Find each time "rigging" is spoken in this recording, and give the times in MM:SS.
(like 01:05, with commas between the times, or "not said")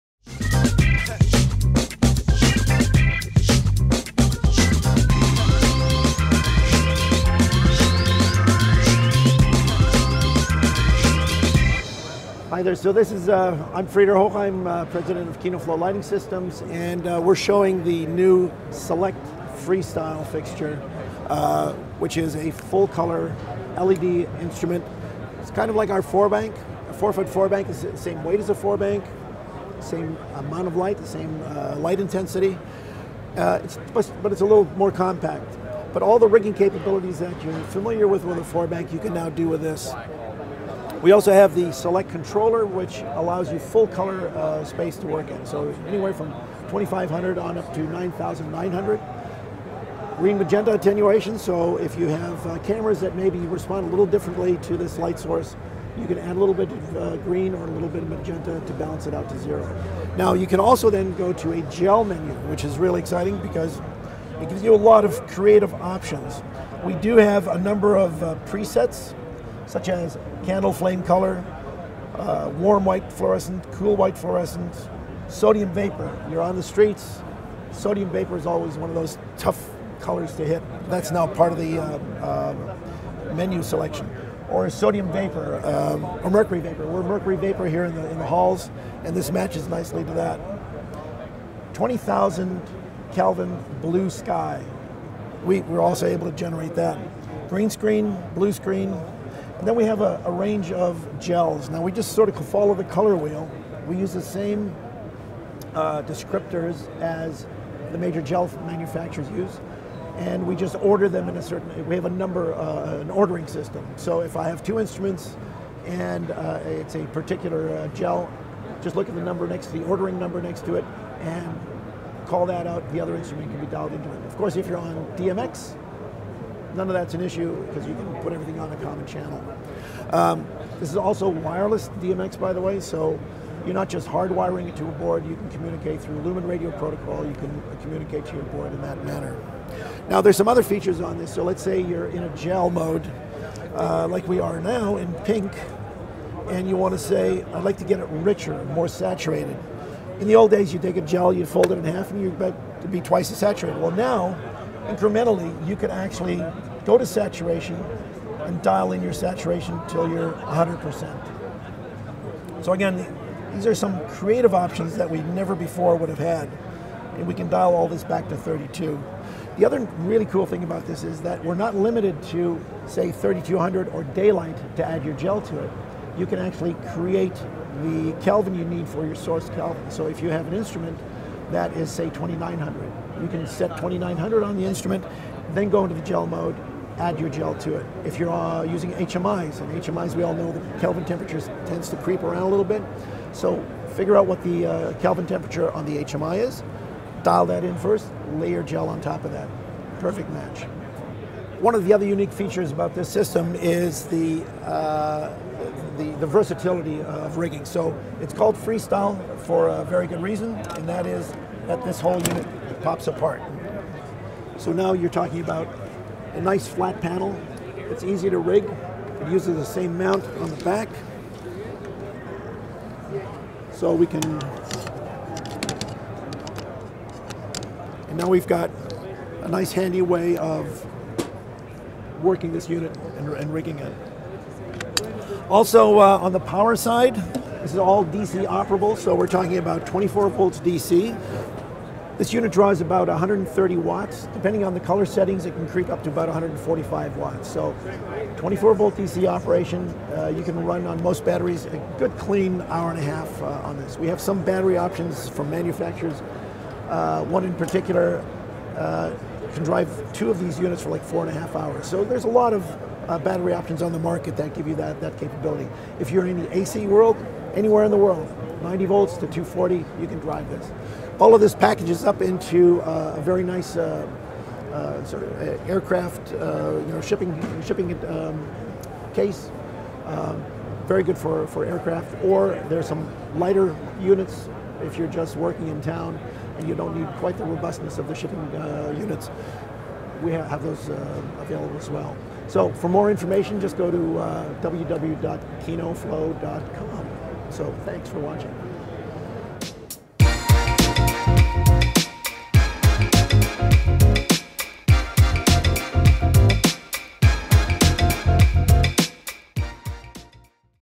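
00:36, 03:27, 03:53.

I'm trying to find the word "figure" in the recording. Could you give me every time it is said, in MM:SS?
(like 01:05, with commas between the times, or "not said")
03:13.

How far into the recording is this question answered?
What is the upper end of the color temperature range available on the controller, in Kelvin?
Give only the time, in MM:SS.
00:47.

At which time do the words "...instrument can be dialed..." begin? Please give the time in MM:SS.
02:03.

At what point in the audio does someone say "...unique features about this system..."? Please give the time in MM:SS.
03:22.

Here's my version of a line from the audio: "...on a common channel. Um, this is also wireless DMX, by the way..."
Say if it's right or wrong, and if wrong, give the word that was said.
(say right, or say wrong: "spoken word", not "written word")
right.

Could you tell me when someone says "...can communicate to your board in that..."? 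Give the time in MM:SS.
02:17.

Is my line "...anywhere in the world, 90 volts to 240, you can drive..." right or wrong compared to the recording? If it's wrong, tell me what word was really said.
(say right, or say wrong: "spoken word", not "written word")
right.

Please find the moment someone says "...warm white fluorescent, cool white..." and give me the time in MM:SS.
01:12.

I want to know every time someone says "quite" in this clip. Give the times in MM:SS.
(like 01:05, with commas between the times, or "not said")
04:47.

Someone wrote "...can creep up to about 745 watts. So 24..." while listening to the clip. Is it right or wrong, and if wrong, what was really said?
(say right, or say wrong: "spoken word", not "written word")
wrong: "145", not "745".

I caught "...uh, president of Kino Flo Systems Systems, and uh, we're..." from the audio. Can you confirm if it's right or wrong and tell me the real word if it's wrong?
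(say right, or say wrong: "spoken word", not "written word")
wrong: "Lighting", not "Systems".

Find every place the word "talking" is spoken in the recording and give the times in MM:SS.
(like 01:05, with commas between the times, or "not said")
03:35, 03:59.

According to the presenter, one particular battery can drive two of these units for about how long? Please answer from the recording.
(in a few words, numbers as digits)
4.5 hours.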